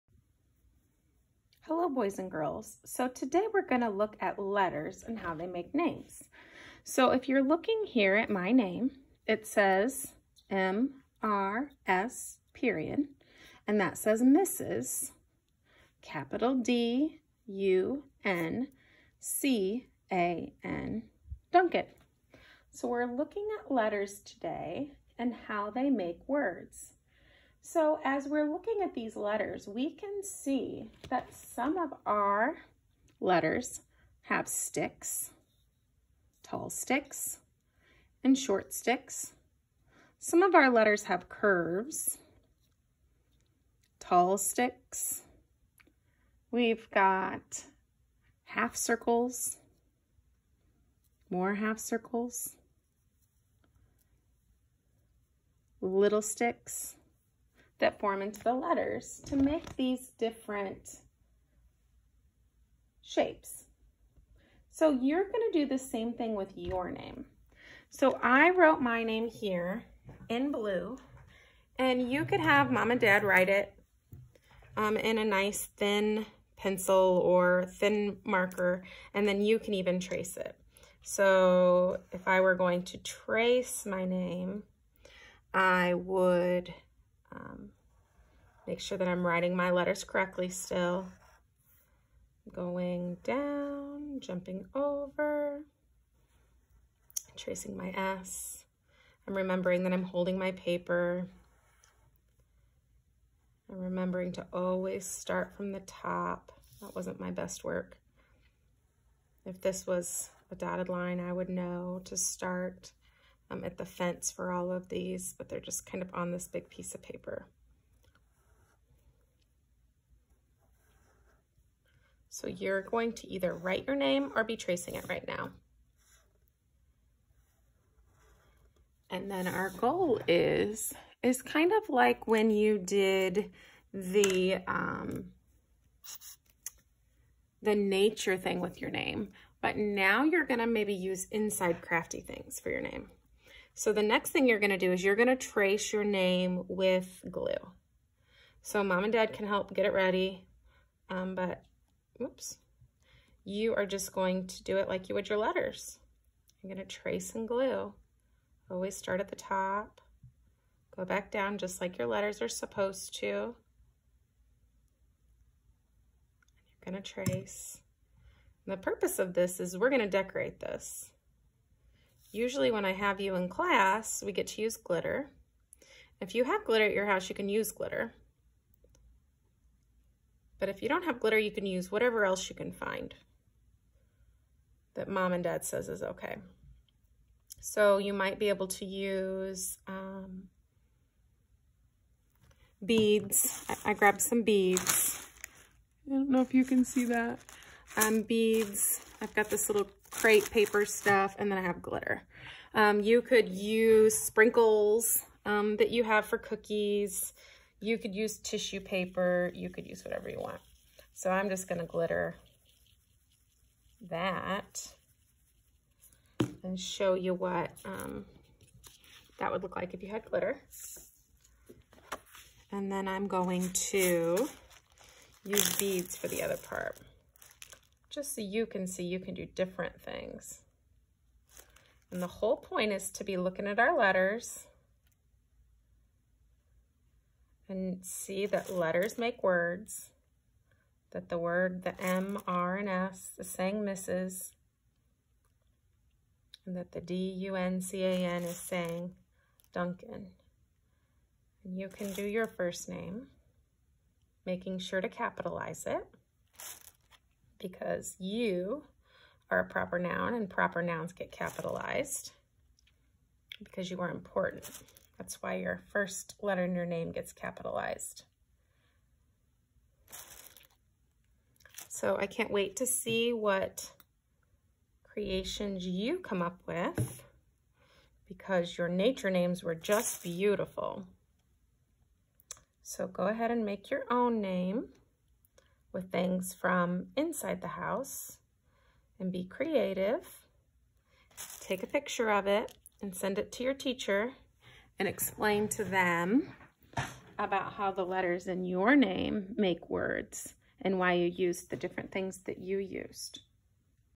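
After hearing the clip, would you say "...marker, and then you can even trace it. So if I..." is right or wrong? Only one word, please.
right.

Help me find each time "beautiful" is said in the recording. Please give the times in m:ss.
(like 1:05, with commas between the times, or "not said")
4:40.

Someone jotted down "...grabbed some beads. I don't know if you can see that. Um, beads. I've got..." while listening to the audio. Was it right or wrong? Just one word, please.
right.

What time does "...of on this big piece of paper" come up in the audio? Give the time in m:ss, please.
1:56.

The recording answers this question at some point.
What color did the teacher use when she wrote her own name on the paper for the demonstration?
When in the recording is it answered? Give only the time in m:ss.
1:10.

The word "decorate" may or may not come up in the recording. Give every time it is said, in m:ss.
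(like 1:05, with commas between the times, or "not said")
2:50.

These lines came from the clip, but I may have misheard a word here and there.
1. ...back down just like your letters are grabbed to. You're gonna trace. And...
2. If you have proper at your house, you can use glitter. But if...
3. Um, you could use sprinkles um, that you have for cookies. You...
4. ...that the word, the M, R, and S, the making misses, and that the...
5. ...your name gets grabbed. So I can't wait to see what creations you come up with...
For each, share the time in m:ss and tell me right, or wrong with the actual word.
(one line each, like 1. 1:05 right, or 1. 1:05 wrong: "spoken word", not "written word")
1. 2:41 wrong: "supposed", not "grabbed"
2. 2:56 wrong: "glitter", not "proper"
3. 3:22 right
4. 4:01 wrong: "saying", not "making"
5. 4:26 wrong: "capitalized", not "grabbed".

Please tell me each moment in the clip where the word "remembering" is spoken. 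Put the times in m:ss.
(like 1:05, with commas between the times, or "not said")
1:39, 1:43.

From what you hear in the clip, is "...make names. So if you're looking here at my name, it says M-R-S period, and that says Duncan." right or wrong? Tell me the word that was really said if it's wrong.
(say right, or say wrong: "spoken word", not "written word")
wrong: "Mrs", not "Duncan".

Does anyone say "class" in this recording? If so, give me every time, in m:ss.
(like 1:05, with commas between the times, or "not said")
2:53.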